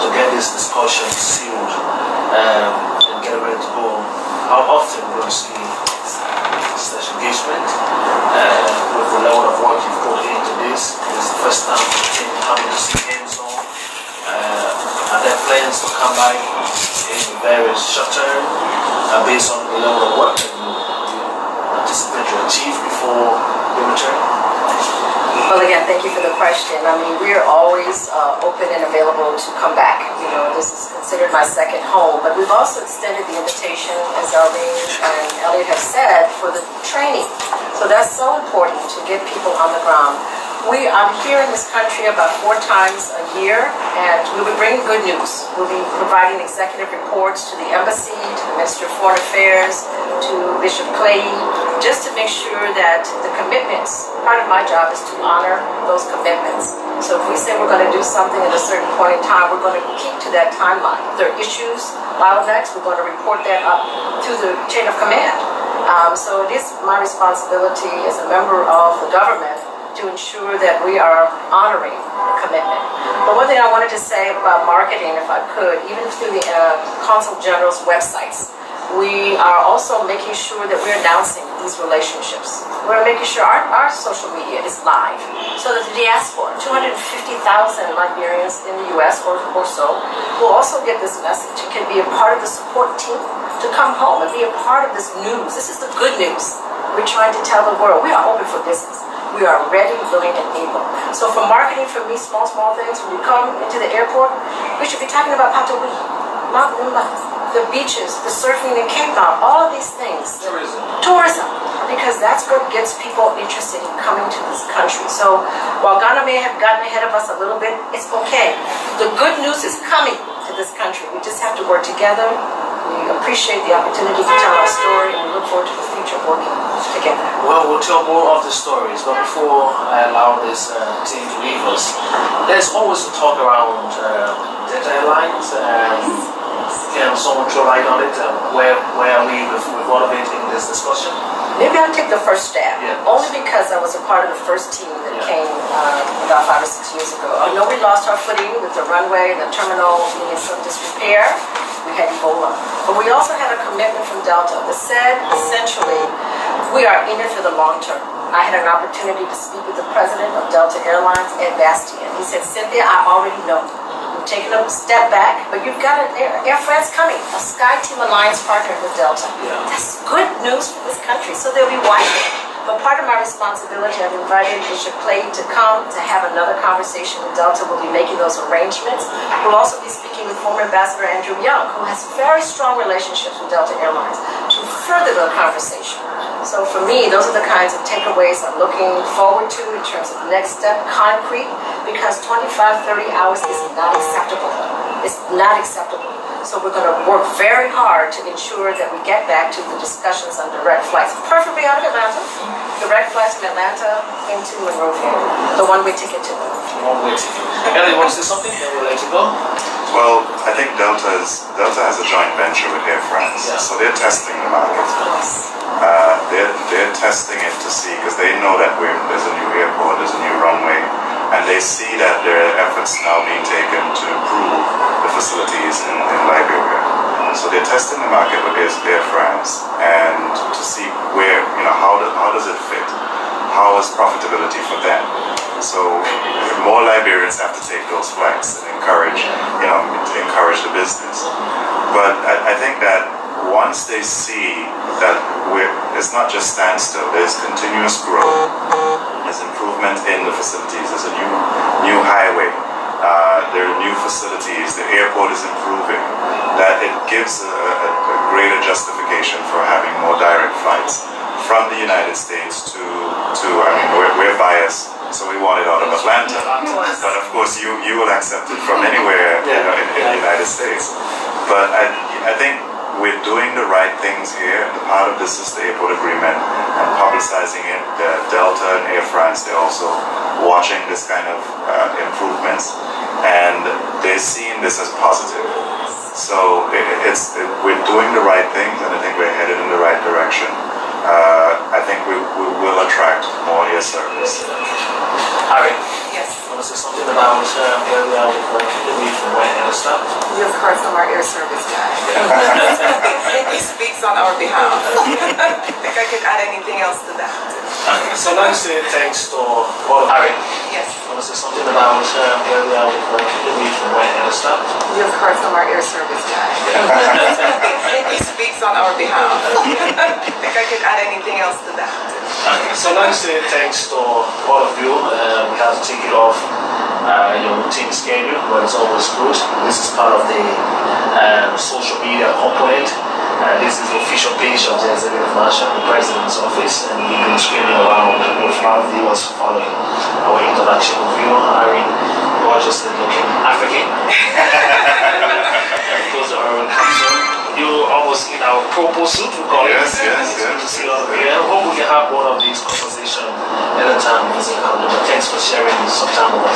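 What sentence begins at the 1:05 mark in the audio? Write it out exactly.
Um, so it is my responsibility as a member of the government to ensure that we are honoring the commitment.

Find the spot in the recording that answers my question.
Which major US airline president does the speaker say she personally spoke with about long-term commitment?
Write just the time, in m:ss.
2:41.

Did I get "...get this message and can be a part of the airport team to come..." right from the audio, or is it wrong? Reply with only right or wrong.
wrong.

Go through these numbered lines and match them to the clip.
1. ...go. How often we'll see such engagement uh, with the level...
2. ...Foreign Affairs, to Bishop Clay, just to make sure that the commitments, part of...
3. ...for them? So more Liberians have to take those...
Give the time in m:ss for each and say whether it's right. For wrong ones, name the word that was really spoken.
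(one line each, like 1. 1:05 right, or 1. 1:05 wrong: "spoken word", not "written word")
1. 0:03 right
2. 0:49 right
3. 3:54 right.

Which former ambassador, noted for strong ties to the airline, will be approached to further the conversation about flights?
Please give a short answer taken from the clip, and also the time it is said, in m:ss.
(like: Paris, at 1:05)
Andrew Young, at 3:01.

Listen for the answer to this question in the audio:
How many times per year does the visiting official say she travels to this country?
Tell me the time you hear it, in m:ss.
0:42.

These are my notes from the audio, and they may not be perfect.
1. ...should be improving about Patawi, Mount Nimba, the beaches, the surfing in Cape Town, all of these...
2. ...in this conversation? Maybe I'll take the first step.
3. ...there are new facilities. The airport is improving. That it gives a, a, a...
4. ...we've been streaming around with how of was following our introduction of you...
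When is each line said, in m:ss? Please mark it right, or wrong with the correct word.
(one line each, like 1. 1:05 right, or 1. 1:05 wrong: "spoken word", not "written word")
1. 1:44 wrong: "talking", not "improving"
2. 2:20 wrong: "discussion", not "conversation"
3. 4:13 right
4. 5:37 right.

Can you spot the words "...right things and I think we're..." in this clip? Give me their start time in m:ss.
4:48.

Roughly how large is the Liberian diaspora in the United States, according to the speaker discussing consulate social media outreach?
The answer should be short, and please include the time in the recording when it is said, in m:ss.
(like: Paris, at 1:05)
250,000, at 1:26.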